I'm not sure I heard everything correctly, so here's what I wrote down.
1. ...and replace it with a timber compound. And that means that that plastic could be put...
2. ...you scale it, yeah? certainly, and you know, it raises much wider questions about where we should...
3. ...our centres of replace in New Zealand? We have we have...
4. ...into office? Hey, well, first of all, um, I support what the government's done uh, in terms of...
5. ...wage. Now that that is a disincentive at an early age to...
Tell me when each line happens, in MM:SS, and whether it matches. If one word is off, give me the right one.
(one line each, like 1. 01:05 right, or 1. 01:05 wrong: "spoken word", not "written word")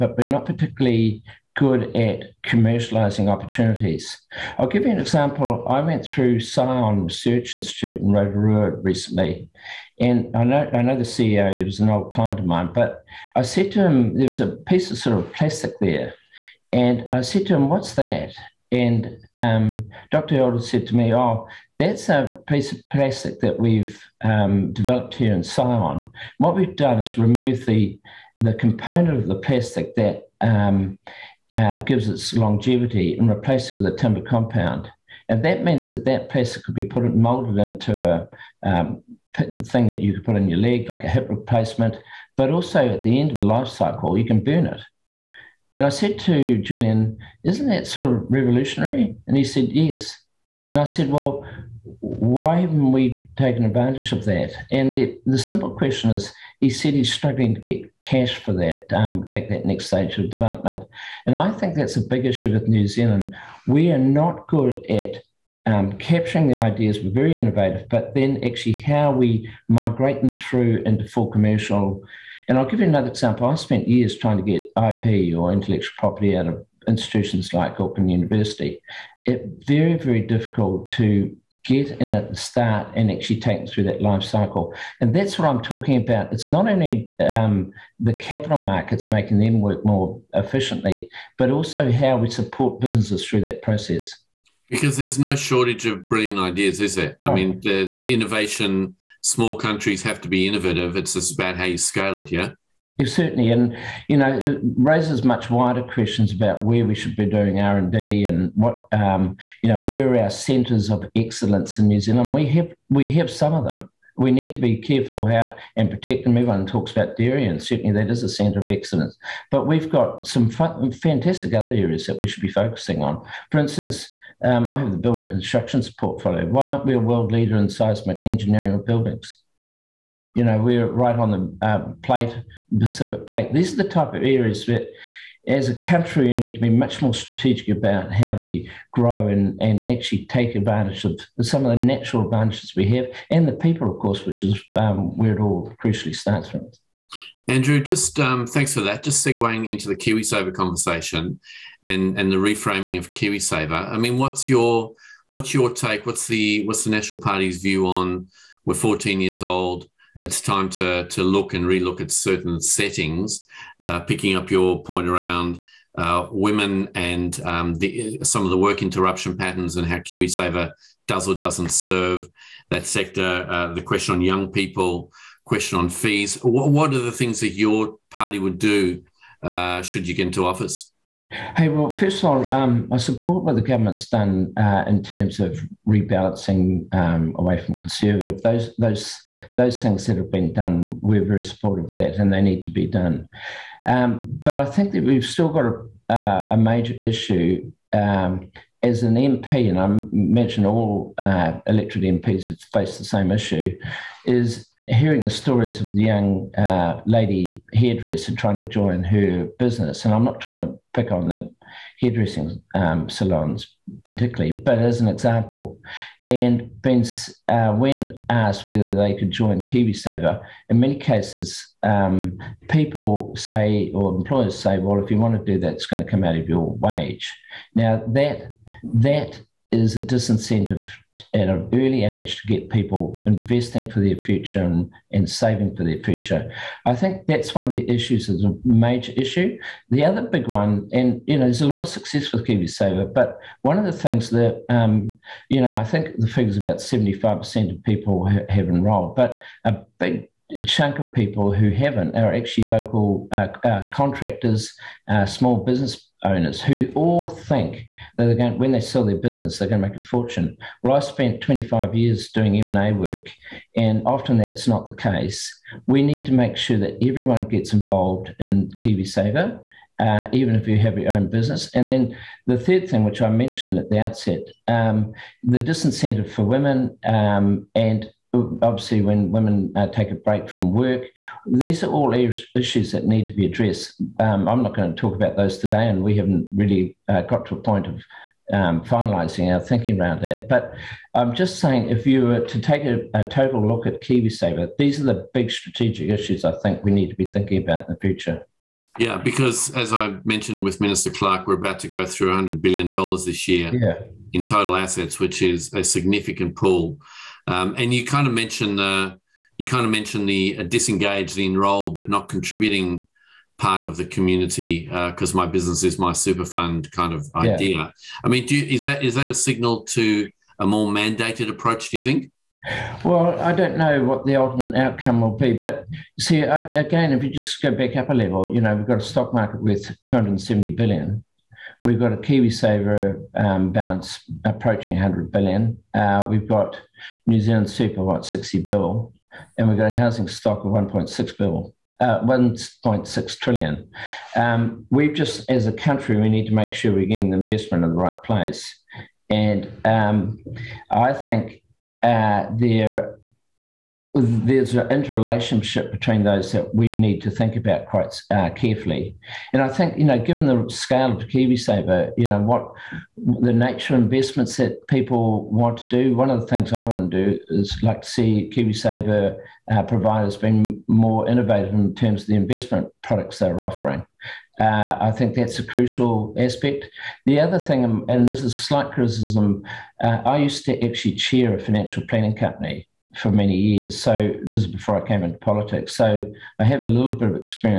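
1. 00:33 right
2. 01:41 right
3. 01:50 wrong: "excellence", not "replace"
4. 03:00 right
5. 03:46 right.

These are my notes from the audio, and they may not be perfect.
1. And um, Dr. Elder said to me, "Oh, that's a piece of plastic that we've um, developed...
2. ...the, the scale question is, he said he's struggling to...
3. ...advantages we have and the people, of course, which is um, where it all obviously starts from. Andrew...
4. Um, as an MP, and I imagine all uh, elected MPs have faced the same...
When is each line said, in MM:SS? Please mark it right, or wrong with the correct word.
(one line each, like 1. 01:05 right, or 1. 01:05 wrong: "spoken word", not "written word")
1. 00:18 right
2. 00:54 wrong: "simple", not "scale"
3. 02:22 wrong: "crucially", not "obviously"
4. 03:17 right.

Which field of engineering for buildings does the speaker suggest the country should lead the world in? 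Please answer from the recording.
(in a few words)
Seismic engineering.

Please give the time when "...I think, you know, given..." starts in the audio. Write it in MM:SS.
05:59.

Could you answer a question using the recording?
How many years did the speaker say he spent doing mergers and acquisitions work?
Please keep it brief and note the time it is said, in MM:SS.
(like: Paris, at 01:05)
25 years, at 04:21.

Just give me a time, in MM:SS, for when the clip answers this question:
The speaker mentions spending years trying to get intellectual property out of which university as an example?
01:17.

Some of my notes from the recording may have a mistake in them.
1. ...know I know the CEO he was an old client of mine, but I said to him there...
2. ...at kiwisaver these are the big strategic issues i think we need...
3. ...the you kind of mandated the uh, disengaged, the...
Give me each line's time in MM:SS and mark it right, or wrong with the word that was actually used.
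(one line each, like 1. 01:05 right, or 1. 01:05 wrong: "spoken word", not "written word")
1. 00:10 right
2. 04:53 right
3. 05:08 wrong: "mentioned", not "mandated".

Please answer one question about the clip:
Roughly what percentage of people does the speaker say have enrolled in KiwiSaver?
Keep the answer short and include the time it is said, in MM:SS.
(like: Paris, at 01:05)
75%, at 04:06.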